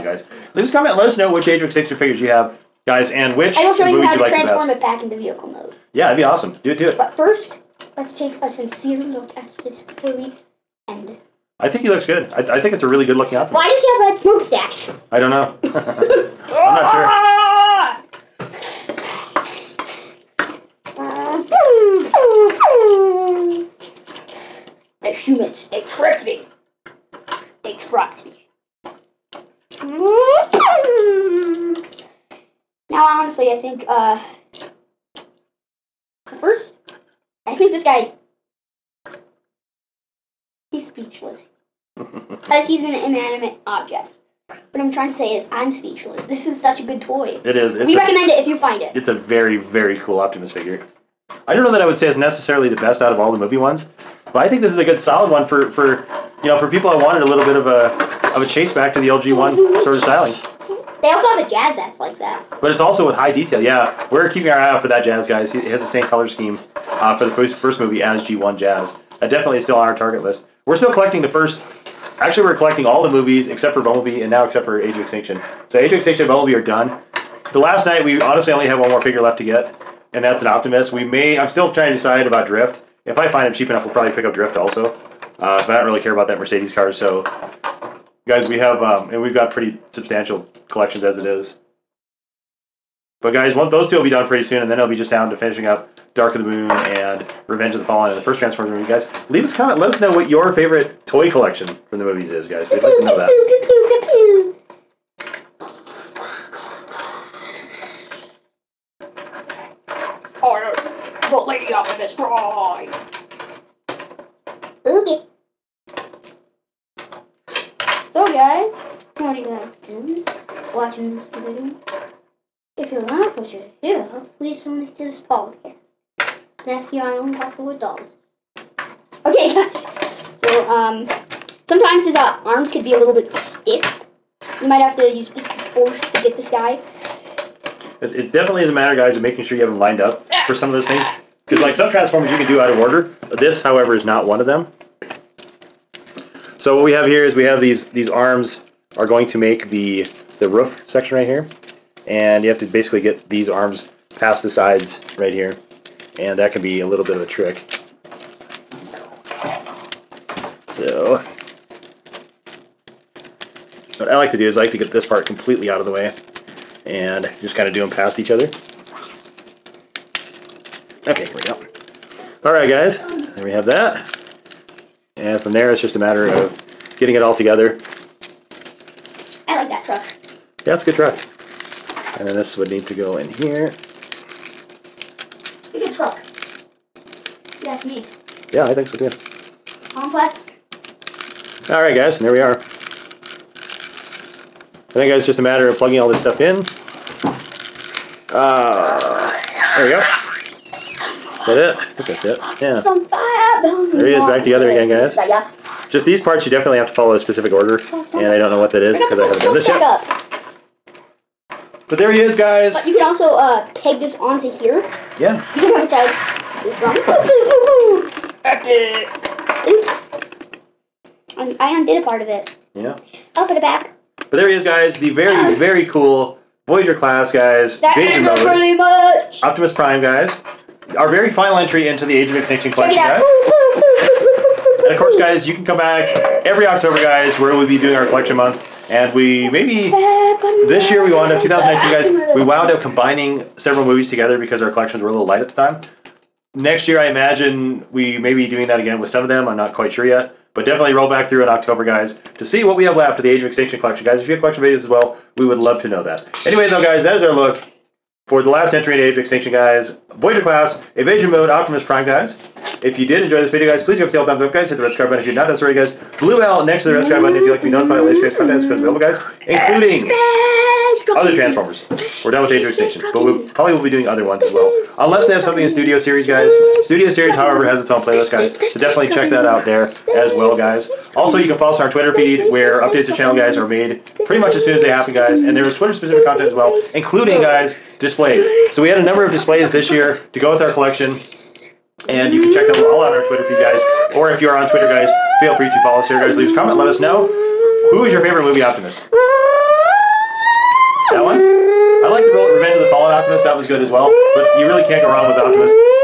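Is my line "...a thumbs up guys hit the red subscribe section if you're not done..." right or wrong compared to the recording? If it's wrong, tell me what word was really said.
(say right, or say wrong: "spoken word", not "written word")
wrong: "button", not "section".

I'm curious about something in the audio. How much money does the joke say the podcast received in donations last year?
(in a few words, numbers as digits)
$4.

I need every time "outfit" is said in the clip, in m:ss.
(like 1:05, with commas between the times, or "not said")
0:13.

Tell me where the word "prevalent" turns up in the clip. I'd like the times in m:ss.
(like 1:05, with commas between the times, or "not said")
not said.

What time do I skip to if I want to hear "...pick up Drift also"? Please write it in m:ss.
1:24.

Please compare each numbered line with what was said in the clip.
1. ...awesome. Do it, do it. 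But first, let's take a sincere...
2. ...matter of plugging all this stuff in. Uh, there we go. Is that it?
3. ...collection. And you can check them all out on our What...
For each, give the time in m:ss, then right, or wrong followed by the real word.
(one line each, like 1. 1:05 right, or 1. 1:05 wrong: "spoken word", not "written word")
1. 0:06 right
2. 3:15 right
3. 4:50 wrong: "Twitter", not "What".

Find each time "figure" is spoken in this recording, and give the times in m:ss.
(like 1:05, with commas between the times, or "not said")
0:01, 0:50, 1:18.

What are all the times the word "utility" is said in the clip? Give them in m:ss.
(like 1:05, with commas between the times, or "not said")
not said.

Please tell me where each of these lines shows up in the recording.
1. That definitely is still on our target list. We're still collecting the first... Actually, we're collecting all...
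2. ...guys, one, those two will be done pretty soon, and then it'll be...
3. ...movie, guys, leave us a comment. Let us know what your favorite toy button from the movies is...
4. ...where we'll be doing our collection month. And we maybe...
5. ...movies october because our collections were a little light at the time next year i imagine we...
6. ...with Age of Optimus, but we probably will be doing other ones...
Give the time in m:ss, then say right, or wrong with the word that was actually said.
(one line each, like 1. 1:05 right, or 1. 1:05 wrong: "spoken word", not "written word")
1. 1:09 right
2. 1:33 right
3. 1:38 wrong: "collection", not "button"
4. 3:57 right
5. 4:03 wrong: "together", not "october"
6. 4:32 wrong: "Extinction", not "Optimus".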